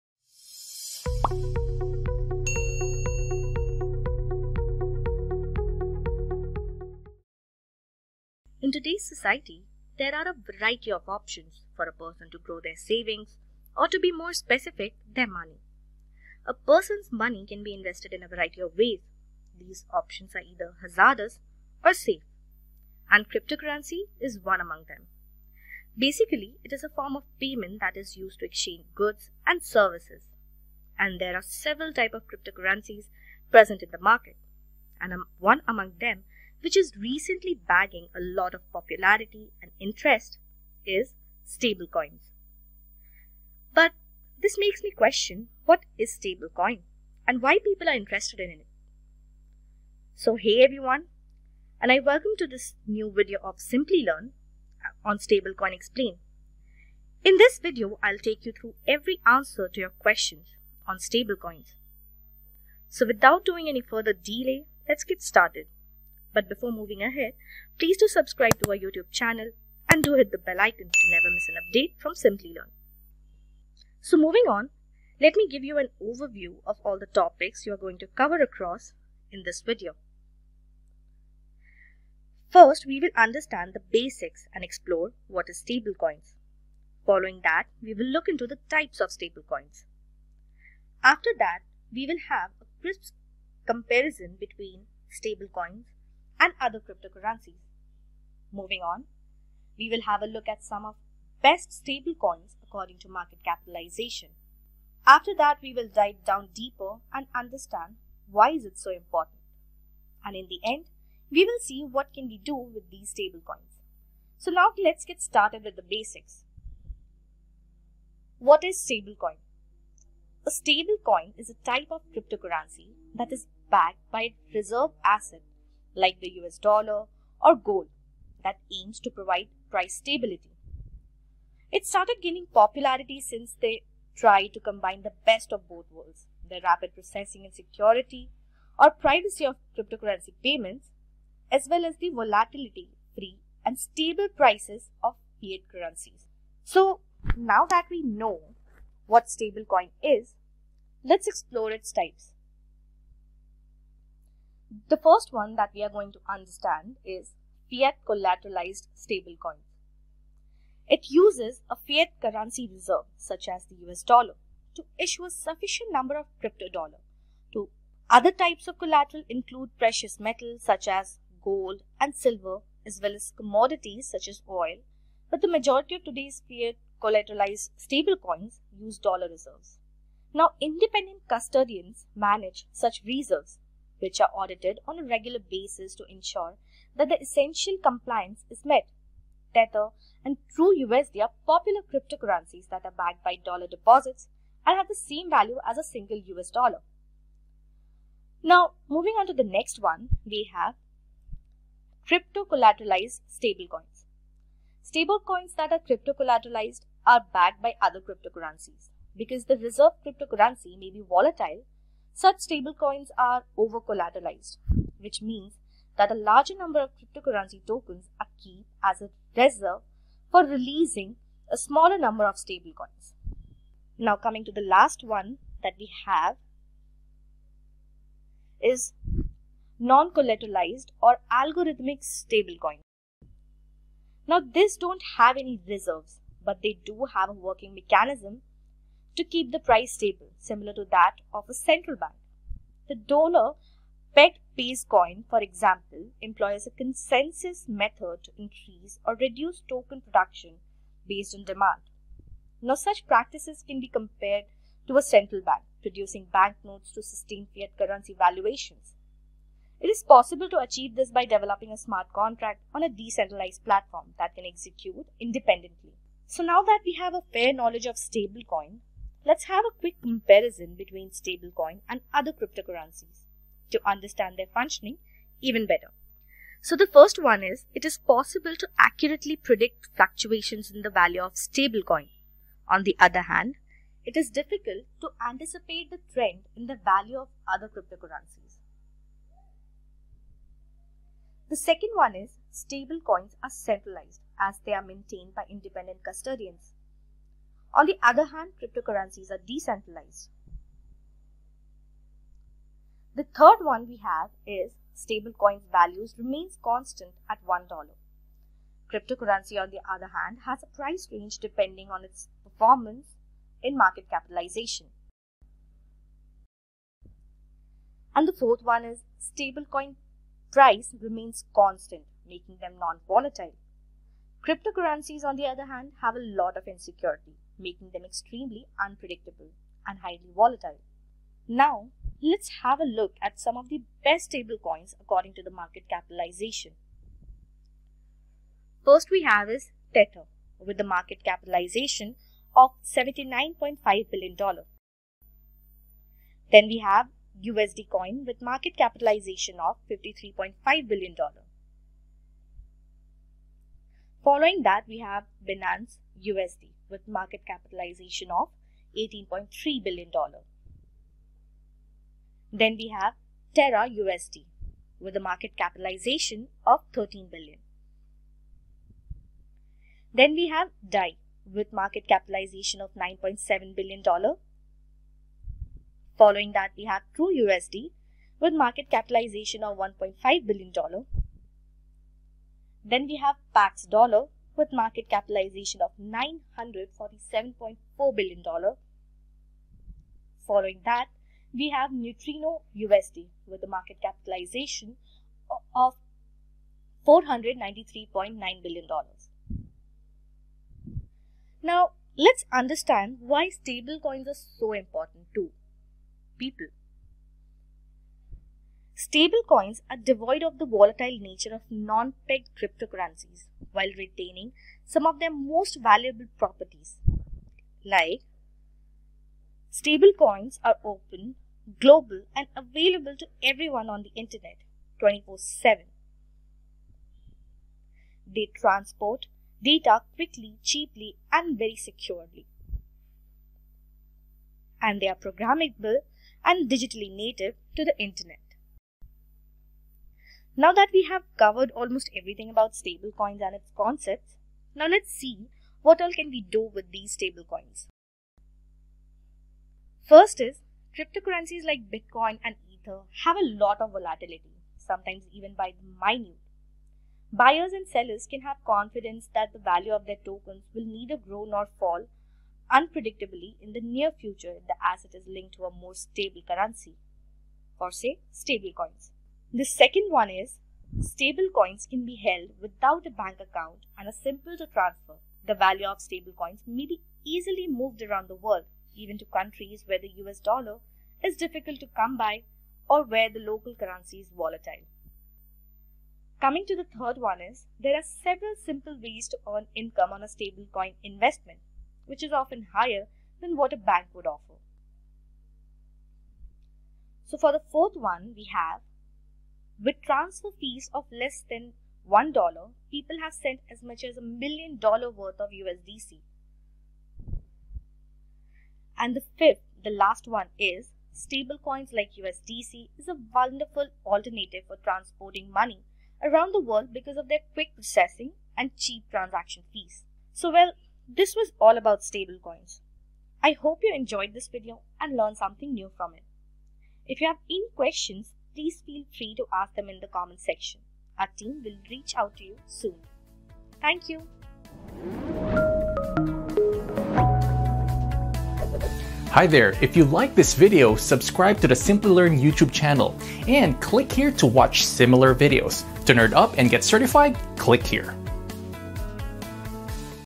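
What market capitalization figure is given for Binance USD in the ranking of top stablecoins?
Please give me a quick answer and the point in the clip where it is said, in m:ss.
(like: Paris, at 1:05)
$18.3 billion, at 5:58.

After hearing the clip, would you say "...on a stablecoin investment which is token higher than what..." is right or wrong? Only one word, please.
wrong.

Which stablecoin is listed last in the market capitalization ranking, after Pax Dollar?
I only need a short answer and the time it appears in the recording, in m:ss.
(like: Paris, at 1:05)
Neutrino USD, at 6:31.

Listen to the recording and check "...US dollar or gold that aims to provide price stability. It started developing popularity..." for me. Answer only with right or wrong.
wrong.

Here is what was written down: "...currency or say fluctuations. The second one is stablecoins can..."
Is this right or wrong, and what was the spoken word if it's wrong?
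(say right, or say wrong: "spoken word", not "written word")
wrong: "stablecoins", not "fluctuations".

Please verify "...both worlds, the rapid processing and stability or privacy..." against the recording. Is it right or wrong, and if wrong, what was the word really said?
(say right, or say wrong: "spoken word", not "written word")
wrong: "security", not "stability".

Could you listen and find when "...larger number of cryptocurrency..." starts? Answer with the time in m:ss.
3:36.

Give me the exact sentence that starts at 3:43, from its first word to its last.
Now, coming to the last one that we have is non collateralized or algorithmic stablecoin.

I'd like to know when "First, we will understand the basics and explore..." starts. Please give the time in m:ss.
1:22.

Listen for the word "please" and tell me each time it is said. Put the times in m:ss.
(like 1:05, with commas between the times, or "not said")
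1:07, 8:48.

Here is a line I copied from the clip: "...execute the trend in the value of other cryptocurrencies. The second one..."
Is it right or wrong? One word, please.
wrong.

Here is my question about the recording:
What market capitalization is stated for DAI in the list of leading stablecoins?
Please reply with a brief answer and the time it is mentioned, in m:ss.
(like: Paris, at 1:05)
$9.7 billion, at 6:12.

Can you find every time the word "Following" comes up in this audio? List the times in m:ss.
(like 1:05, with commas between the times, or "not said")
1:27, 5:54, 6:16, 6:30.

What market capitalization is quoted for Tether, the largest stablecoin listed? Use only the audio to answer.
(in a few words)
$79.5 billion.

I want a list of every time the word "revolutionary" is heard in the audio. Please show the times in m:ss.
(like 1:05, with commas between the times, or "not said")
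not said.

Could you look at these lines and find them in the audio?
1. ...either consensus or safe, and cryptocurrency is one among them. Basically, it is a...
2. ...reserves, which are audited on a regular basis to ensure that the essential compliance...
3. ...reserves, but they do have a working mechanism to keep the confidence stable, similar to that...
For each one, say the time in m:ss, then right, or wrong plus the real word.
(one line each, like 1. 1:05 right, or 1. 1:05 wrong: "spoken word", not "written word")
1. 0:20 wrong: "hazardous", not "consensus"
2. 3:03 right
3. 3:55 wrong: "price", not "confidence".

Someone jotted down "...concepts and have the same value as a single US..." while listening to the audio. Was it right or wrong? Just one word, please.
wrong.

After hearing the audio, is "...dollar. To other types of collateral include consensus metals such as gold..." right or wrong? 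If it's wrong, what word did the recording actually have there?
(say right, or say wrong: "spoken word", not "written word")
wrong: "precious", not "consensus".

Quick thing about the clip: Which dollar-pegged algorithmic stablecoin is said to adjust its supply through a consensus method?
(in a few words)
base coin.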